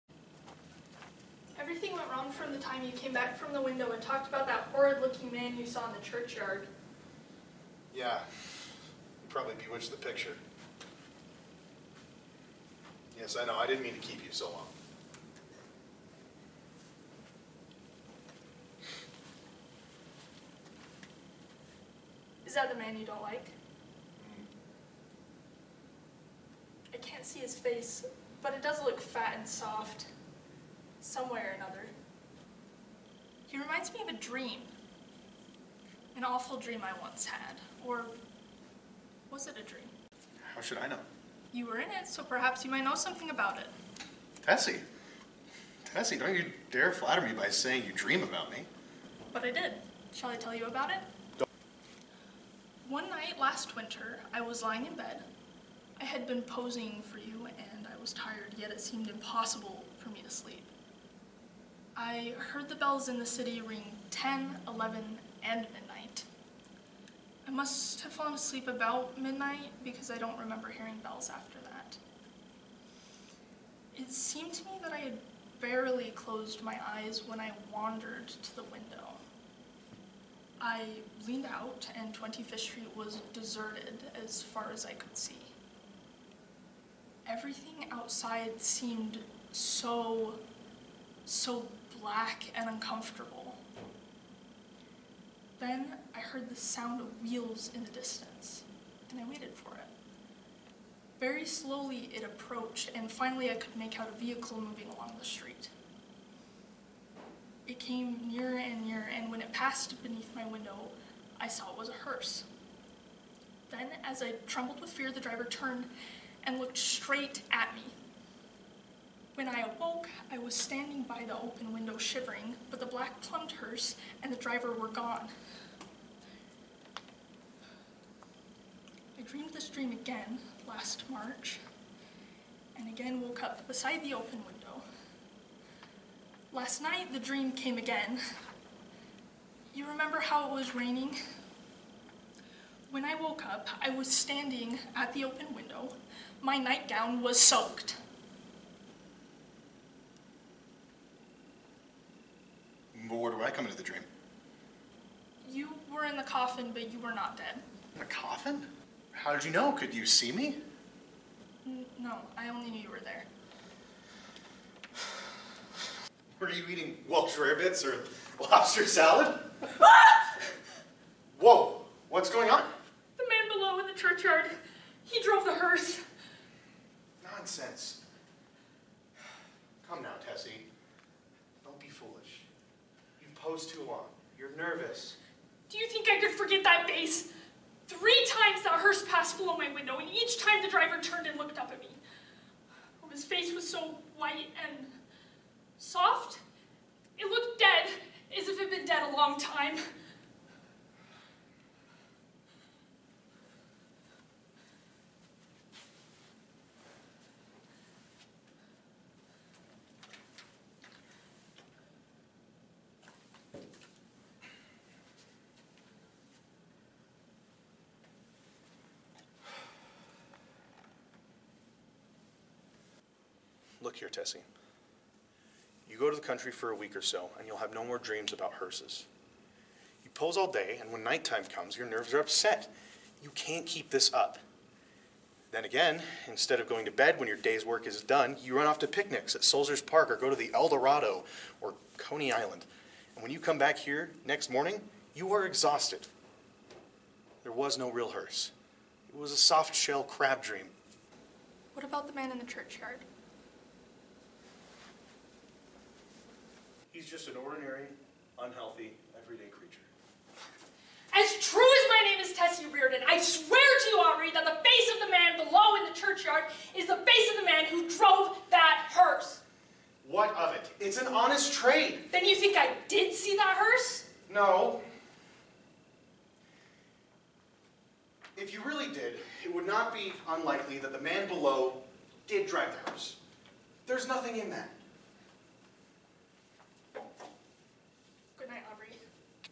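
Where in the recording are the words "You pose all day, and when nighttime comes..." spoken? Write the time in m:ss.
3:50.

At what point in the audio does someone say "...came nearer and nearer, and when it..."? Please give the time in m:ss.
1:47.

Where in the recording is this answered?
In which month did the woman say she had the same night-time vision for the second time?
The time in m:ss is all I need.
2:11.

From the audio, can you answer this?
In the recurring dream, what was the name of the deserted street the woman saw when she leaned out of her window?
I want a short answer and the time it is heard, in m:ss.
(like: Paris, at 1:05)
Twenty Fifth Street, at 1:22.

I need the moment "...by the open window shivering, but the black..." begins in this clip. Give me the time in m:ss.
2:01.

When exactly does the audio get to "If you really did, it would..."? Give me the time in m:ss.
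4:38.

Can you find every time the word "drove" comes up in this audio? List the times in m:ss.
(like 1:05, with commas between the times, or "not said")
2:55, 4:27.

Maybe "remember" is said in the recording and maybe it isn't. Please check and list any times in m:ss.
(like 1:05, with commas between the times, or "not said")
1:10, 2:19.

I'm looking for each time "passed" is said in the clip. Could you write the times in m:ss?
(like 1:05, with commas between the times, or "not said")
1:49, 3:09.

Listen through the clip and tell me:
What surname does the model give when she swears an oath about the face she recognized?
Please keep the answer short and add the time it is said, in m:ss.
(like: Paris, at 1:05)
Reardon, at 4:22.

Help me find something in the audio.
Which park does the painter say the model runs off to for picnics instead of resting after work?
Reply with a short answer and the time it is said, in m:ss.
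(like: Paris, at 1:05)
Sulzer's Park, at 3:59.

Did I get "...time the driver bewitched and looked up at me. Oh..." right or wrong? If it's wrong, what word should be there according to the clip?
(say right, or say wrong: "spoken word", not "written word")
wrong: "turned", not "bewitched".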